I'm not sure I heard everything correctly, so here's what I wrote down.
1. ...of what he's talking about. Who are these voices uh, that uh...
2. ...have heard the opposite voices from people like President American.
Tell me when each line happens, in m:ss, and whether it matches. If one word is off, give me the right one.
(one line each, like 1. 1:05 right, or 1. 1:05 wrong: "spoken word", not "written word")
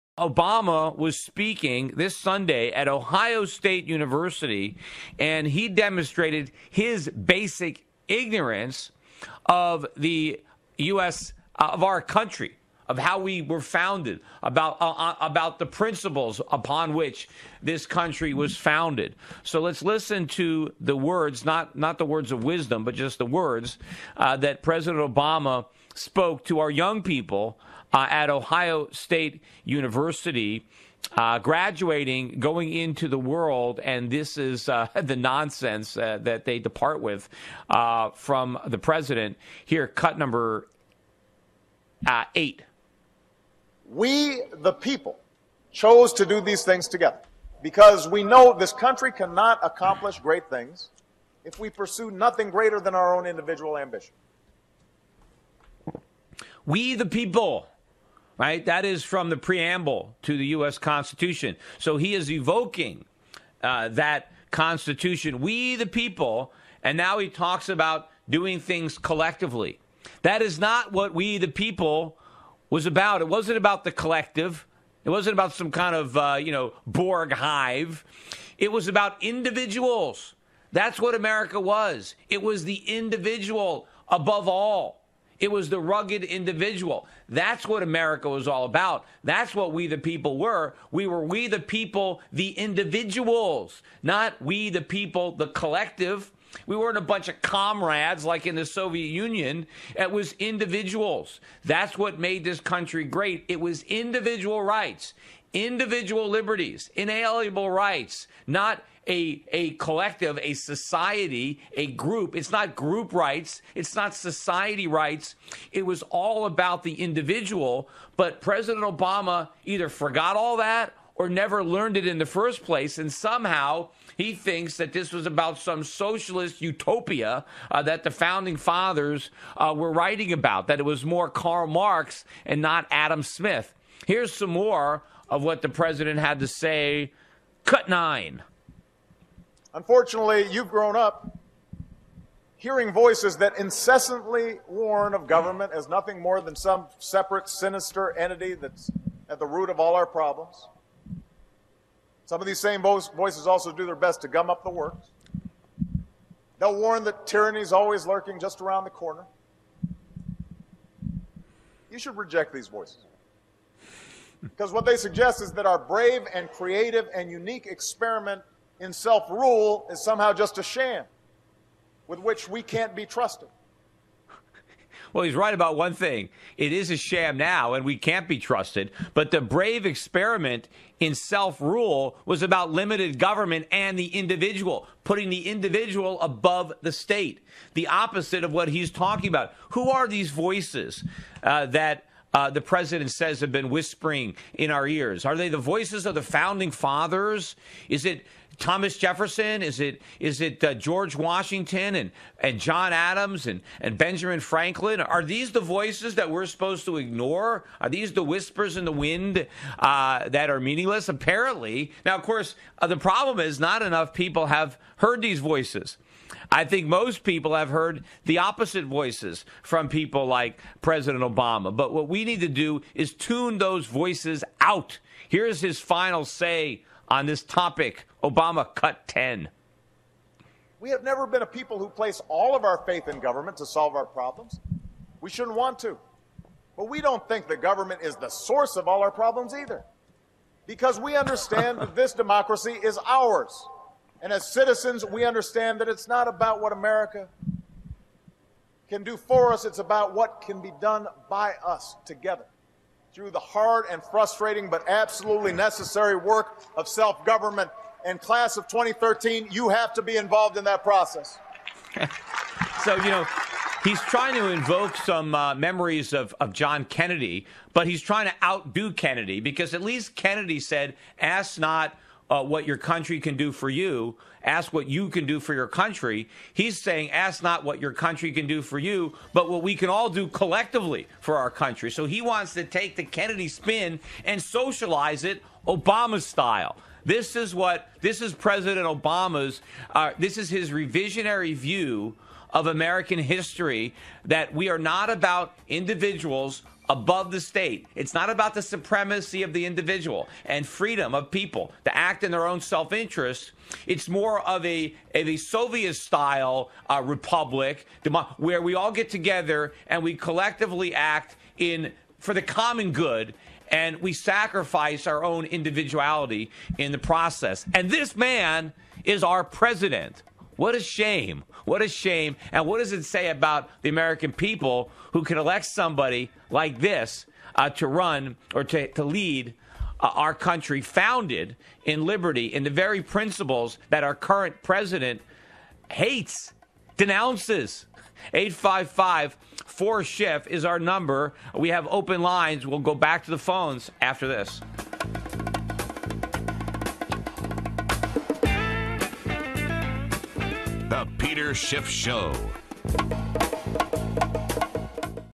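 1. 3:08 right
2. 3:37 wrong: "Obama", not "American".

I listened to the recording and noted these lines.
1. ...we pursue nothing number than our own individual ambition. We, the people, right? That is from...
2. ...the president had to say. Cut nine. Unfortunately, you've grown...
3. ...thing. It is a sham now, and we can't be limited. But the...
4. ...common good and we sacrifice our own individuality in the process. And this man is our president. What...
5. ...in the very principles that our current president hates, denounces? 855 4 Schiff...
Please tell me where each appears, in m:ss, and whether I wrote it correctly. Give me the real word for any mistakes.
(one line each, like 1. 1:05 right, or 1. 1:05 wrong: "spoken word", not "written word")
1. 0:51 wrong: "greater", not "number"
2. 2:15 right
3. 2:55 wrong: "trusted", not "limited"
4. 5:12 right
5. 5:32 right.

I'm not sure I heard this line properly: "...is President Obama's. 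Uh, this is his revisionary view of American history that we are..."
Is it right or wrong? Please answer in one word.
right.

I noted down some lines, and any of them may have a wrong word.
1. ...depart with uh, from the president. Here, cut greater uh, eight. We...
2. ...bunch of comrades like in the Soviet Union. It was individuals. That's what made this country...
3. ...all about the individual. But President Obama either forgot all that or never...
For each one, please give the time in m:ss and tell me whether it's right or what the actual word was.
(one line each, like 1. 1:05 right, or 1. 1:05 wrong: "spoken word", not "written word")
1. 0:36 wrong: "number", not "greater"
2. 1:37 right
3. 1:56 right.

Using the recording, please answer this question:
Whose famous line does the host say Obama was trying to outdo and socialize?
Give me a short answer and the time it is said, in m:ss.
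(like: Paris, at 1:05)
John Kennedy, at 4:26.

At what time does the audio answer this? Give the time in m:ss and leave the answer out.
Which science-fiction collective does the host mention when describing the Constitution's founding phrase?
1:16.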